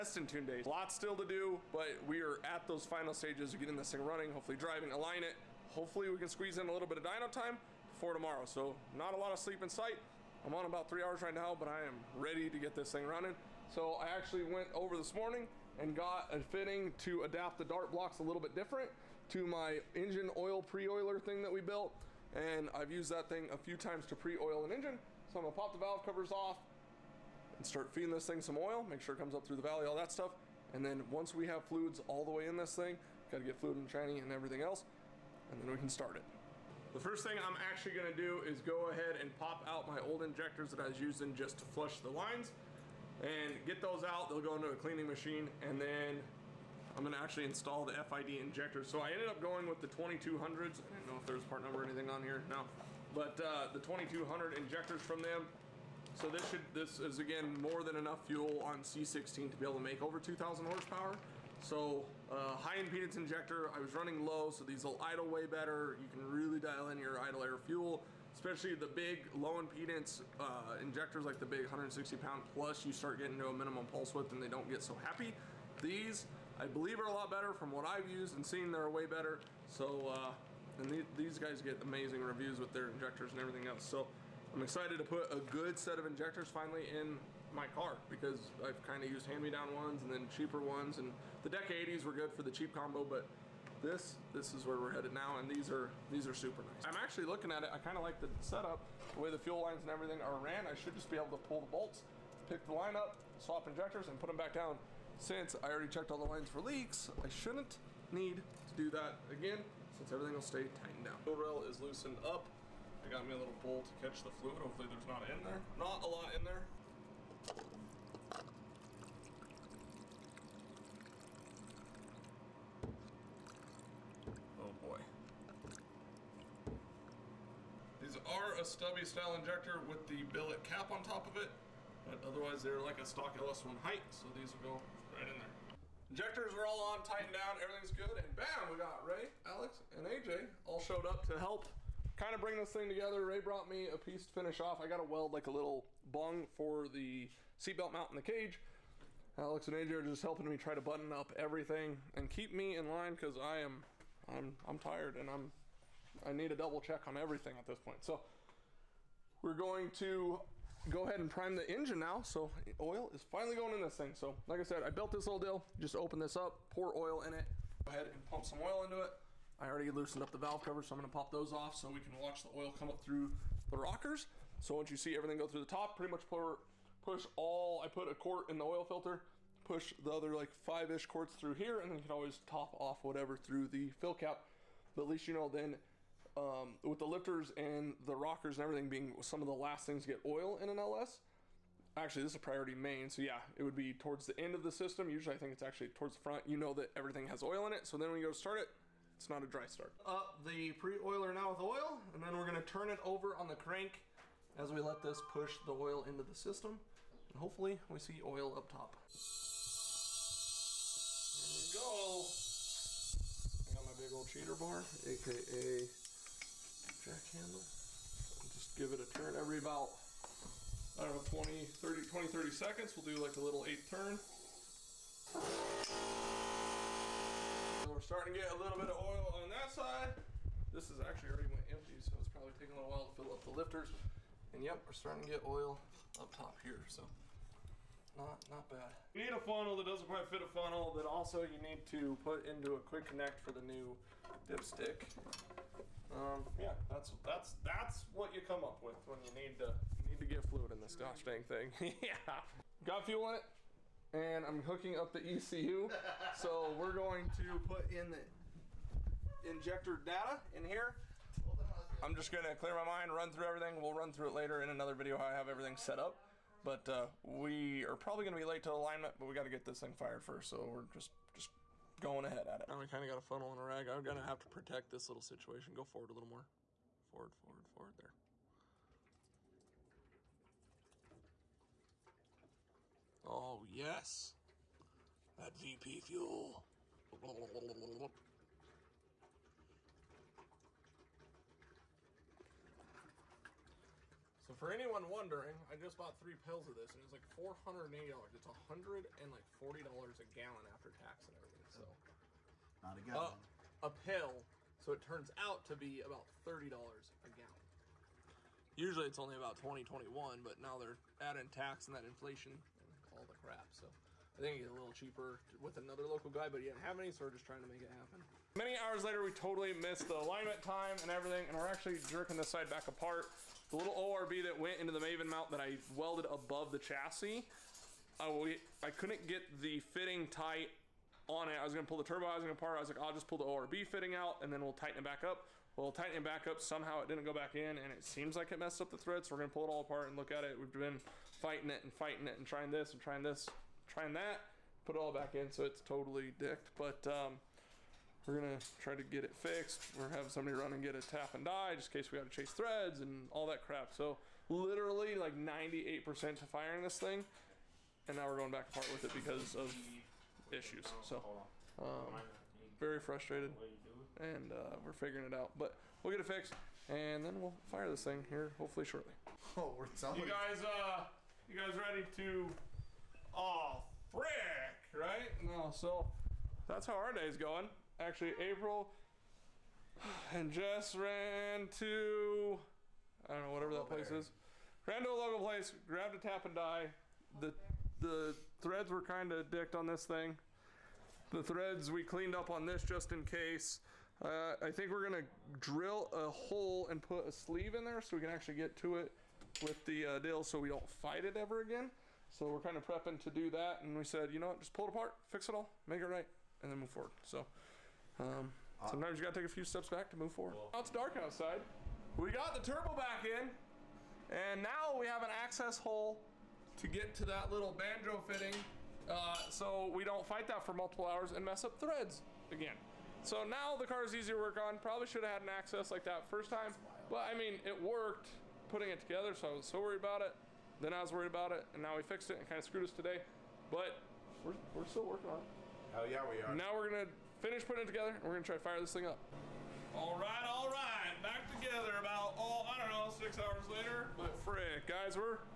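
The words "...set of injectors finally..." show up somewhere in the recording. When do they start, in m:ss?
1:25.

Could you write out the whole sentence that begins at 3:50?
This is actually already went empty, so it's probably taking a little while to fill up the lifters.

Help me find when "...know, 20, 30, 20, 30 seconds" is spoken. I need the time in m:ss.
3:41.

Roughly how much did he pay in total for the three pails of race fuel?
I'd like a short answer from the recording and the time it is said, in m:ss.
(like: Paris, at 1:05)
$480, at 4:57.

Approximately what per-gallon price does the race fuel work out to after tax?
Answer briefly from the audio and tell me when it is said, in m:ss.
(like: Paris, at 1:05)
$30, at 5:06.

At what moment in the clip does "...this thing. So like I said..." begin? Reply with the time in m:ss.
2:43.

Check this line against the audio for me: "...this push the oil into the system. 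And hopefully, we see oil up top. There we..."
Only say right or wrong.
right.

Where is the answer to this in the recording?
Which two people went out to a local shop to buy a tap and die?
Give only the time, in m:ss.
6:18.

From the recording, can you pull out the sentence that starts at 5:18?
Many hours later, we totally missed the alignment time and everything, and we're actually jerking this side back apart.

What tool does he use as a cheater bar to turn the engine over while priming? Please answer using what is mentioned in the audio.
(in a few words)
Jack handle.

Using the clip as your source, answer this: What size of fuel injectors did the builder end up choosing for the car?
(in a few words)
2200.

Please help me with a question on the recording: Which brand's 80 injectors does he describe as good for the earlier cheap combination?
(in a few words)
Deka.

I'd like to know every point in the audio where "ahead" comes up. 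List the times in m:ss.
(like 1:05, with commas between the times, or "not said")
0:38, 2:41, 2:47, 4:32.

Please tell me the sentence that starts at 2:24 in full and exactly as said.
I got to weld like a little bung for the seatbelt mount in the cage.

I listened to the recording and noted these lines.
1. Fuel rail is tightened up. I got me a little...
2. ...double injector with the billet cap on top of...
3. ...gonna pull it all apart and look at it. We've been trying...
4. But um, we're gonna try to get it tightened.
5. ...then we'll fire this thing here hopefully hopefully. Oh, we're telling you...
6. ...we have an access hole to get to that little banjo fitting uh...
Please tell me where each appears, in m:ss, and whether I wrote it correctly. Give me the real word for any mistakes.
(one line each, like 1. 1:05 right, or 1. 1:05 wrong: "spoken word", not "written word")
1. 1:51 wrong: "loosened", not "tightened"
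2. 2:09 wrong: "style", not "double"
3. 5:39 wrong: "fighting", not "trying"
4. 5:46 wrong: "fixed", not "tightened"
5. 6:07 wrong: "shortly", not "hopefully"
6. 6:54 right.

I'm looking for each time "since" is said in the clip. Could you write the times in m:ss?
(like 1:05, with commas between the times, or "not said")
1:45, 1:49.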